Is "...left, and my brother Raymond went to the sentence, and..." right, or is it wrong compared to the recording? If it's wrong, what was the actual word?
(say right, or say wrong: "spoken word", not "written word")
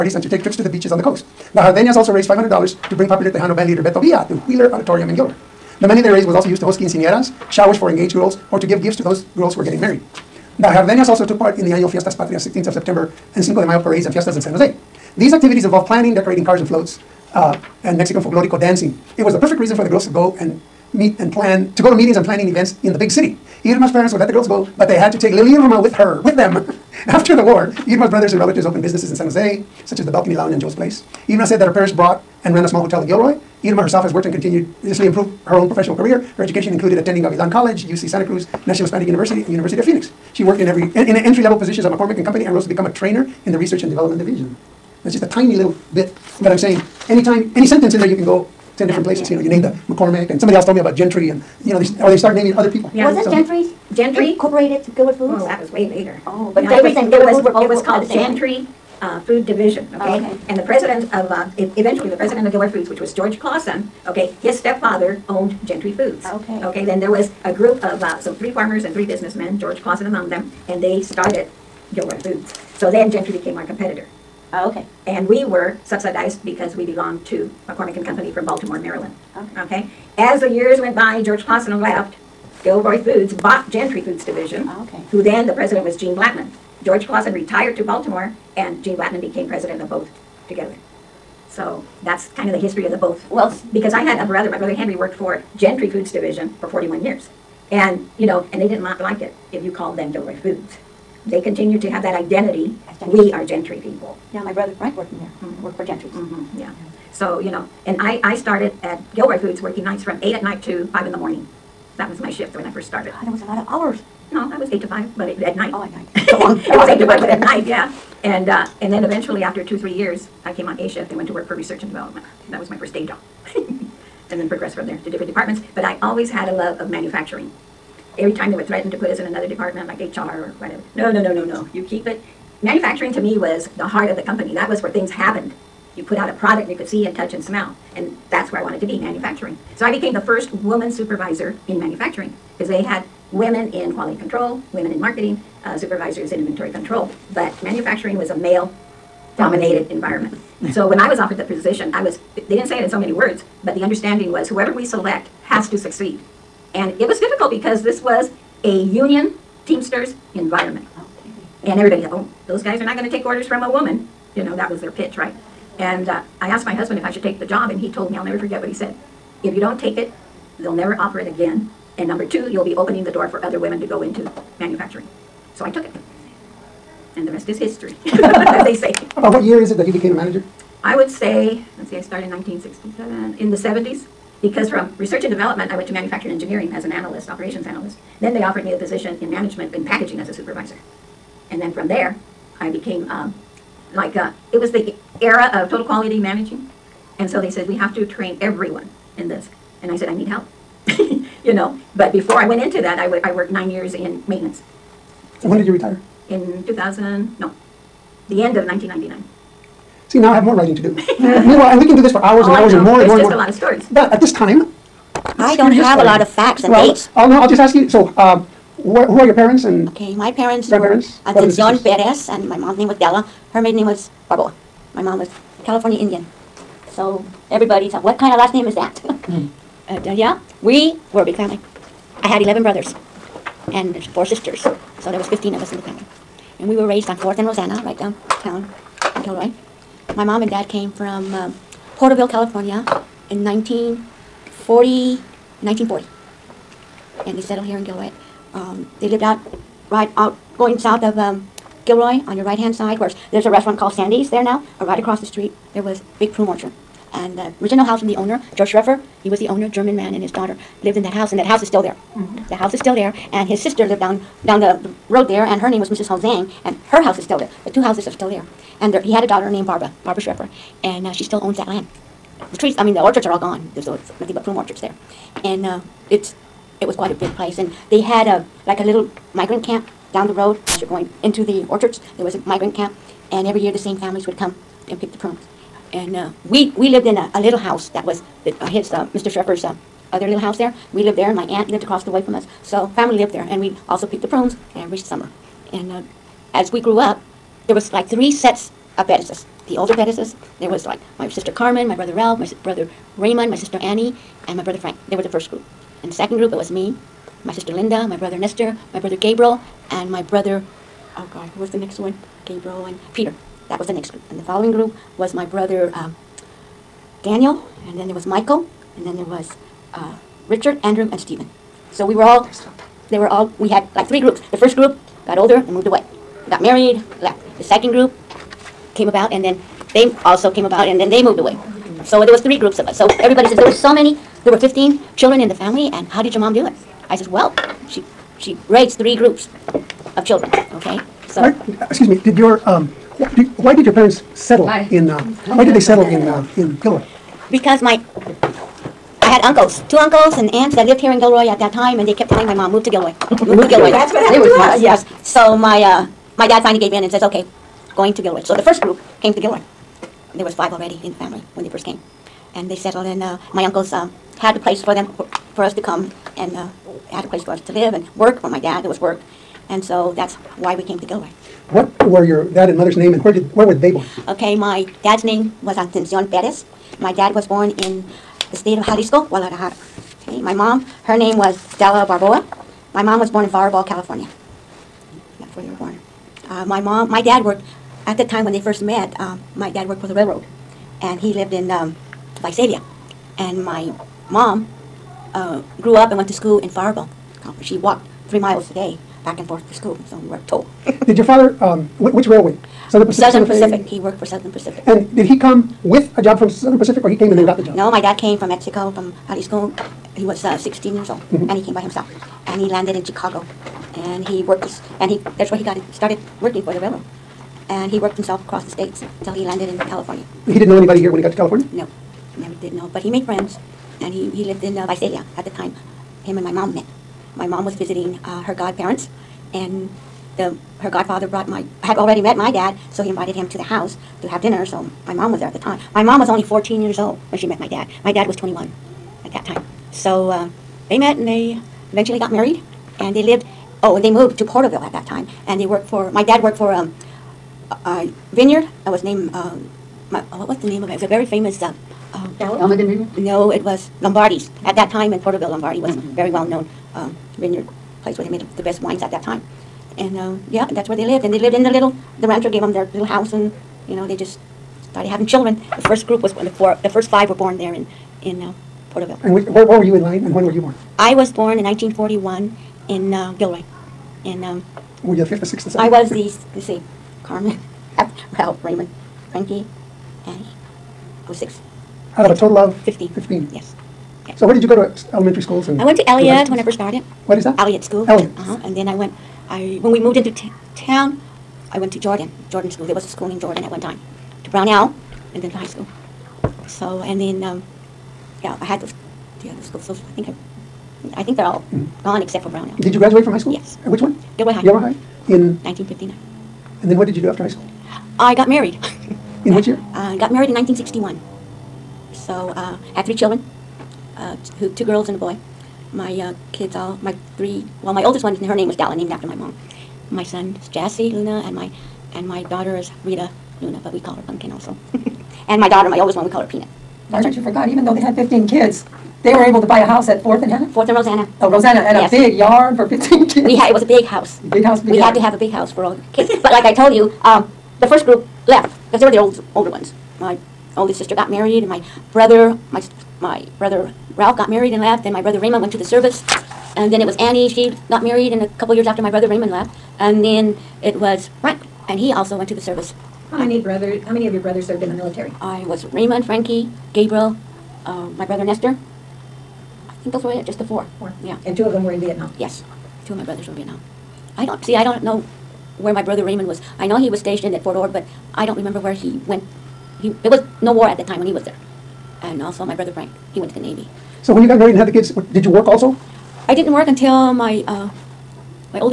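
wrong: "service", not "sentence".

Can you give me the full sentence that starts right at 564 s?
I don't, see, I don't know where my brother Raymond was.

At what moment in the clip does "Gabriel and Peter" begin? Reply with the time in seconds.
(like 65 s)
312 s.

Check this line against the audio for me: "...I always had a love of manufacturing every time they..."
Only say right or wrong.
right.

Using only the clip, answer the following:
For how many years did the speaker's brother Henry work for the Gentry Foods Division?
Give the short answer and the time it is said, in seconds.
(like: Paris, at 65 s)
41, at 96 s.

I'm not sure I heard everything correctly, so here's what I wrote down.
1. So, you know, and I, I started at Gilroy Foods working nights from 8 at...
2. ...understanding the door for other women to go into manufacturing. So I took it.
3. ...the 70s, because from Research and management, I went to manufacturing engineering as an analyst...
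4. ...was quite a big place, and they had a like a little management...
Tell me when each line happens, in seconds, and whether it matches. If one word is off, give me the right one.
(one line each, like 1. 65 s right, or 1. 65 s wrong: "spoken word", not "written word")
1. 107 s right
2. 172 s wrong: "opening", not "understanding"
3. 183 s wrong: "development", not "management"
4. 276 s wrong: "migrant", not "management".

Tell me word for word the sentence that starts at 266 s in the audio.
Hao Zhang, and her house is still there.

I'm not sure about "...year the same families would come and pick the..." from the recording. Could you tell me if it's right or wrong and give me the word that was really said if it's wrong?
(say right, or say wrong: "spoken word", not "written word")
right.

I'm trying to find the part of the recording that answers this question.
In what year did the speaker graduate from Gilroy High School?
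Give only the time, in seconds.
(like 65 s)
505 s.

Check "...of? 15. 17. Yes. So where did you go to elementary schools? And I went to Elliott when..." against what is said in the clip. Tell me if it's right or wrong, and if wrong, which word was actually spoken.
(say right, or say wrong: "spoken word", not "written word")
wrong: "15", not "17".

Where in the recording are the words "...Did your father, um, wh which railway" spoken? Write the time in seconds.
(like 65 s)
401 s.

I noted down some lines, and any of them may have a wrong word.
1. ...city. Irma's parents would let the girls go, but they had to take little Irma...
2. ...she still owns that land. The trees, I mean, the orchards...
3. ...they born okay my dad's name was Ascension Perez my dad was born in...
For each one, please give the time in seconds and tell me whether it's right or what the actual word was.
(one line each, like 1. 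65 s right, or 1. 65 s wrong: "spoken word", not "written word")
1. 23 s right
2. 271 s right
3. 373 s right.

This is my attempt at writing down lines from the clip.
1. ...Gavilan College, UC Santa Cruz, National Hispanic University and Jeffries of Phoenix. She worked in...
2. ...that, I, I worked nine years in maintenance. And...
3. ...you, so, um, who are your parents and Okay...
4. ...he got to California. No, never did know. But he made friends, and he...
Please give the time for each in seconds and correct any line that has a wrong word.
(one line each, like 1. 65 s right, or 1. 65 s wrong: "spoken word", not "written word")
1. 37 s wrong: "University", not "Jeffries"
2. 202 s right
3. 217 s right
4. 421 s right.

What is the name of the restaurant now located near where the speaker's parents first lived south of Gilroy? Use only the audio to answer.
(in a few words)
Sandy's.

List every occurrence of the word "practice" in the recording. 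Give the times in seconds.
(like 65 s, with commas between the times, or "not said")
not said.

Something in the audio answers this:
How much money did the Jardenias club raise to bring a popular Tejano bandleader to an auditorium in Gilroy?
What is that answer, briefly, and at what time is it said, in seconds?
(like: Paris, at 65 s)
$500, at 2 s.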